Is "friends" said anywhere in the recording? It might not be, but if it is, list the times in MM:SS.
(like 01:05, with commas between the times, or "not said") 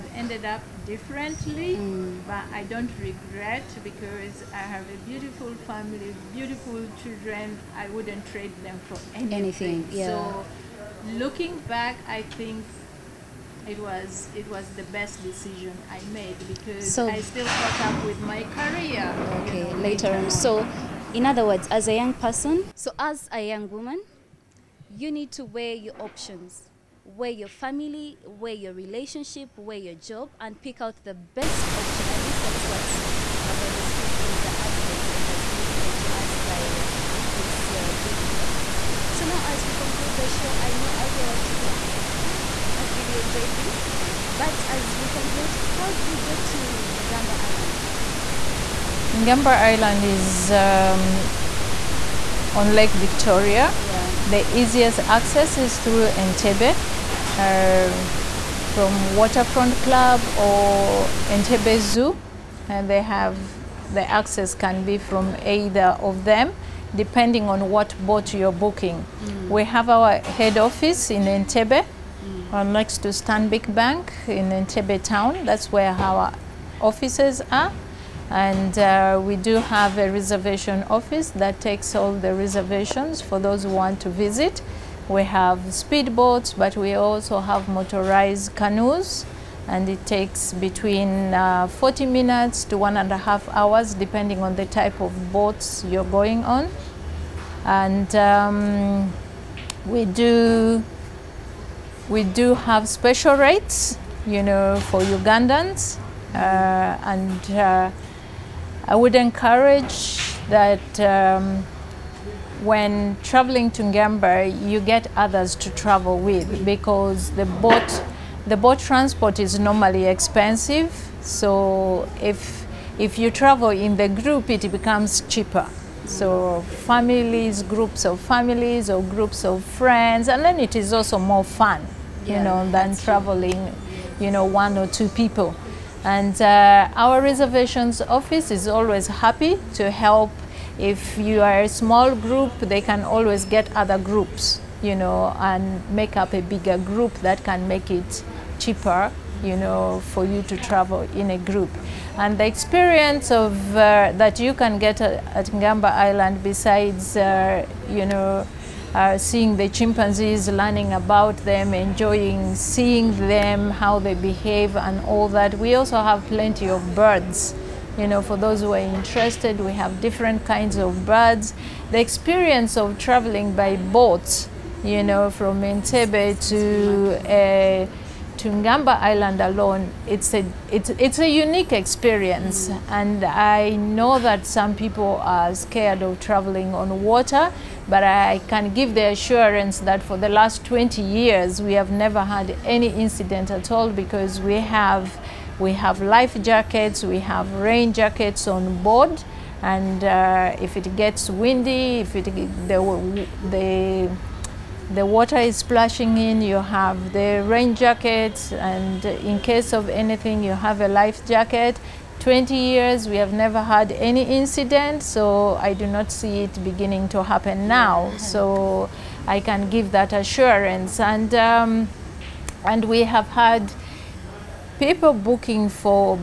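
02:09.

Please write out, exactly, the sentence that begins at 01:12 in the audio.
Uh, next to Stanbic Bank in Entebbe town.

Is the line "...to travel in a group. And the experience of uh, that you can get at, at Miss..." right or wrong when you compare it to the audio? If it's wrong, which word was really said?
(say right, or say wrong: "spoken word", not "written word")
wrong: "Ngamba", not "Miss".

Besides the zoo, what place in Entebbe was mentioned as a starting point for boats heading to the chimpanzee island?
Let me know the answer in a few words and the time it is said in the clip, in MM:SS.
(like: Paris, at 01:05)
Waterfront Club, at 00:59.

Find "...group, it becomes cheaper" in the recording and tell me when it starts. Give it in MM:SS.
02:04.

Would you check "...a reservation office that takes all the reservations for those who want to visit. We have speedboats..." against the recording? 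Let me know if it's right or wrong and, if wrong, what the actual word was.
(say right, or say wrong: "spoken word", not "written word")
right.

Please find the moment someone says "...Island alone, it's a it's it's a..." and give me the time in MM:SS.
02:58.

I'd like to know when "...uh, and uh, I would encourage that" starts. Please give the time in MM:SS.
01:46.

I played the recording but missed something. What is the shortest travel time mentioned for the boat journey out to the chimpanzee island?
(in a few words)
40 minutes.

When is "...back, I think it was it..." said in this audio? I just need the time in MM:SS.
00:11.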